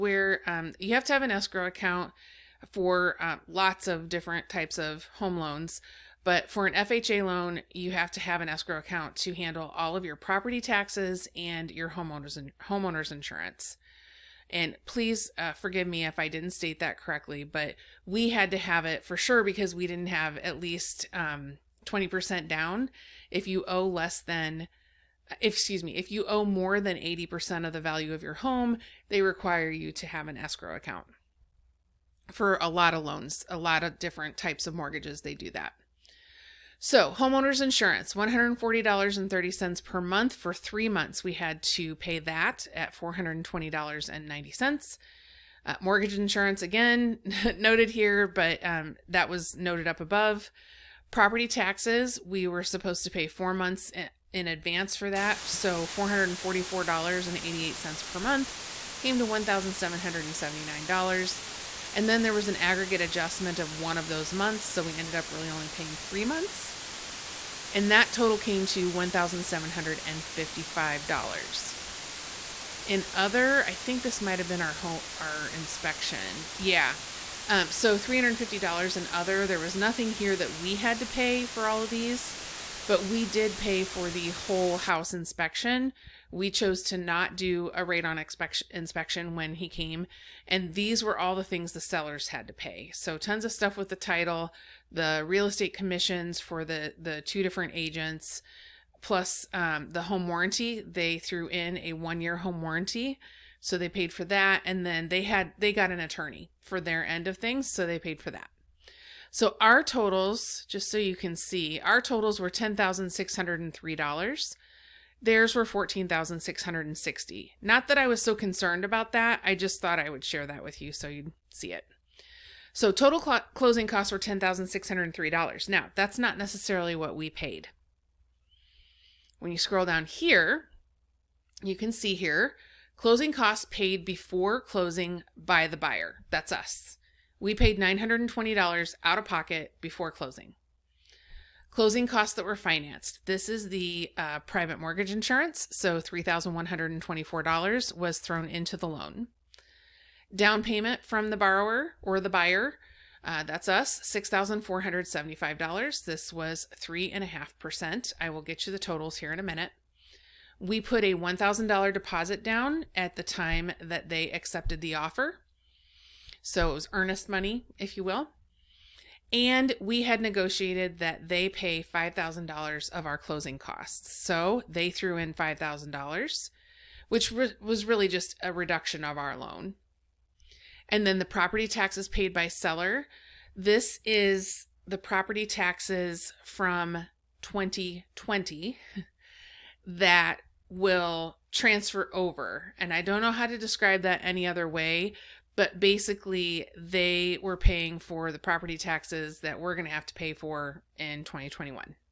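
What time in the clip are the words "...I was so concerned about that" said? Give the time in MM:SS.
01:57.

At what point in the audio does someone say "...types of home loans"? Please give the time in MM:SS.
00:04.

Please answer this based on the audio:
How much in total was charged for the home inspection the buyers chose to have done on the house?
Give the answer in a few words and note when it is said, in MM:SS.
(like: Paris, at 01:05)
$350, at 01:17.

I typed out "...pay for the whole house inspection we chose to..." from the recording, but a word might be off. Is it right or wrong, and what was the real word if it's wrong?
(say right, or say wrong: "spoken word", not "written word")
right.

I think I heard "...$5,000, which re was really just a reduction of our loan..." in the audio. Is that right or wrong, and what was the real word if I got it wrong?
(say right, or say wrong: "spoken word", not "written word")
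right.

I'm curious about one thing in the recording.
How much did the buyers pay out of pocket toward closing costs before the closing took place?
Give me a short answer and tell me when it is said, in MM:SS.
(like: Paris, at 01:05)
$920, at 02:17.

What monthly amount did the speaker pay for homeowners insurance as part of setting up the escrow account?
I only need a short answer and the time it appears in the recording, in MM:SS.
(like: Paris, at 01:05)
$140.30, at 00:38.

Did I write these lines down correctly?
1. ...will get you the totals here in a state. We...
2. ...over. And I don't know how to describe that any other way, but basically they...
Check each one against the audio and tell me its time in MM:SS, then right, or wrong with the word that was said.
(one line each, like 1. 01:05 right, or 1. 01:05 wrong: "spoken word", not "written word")
1. 02:38 wrong: "minute", not "state"
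2. 03:12 right.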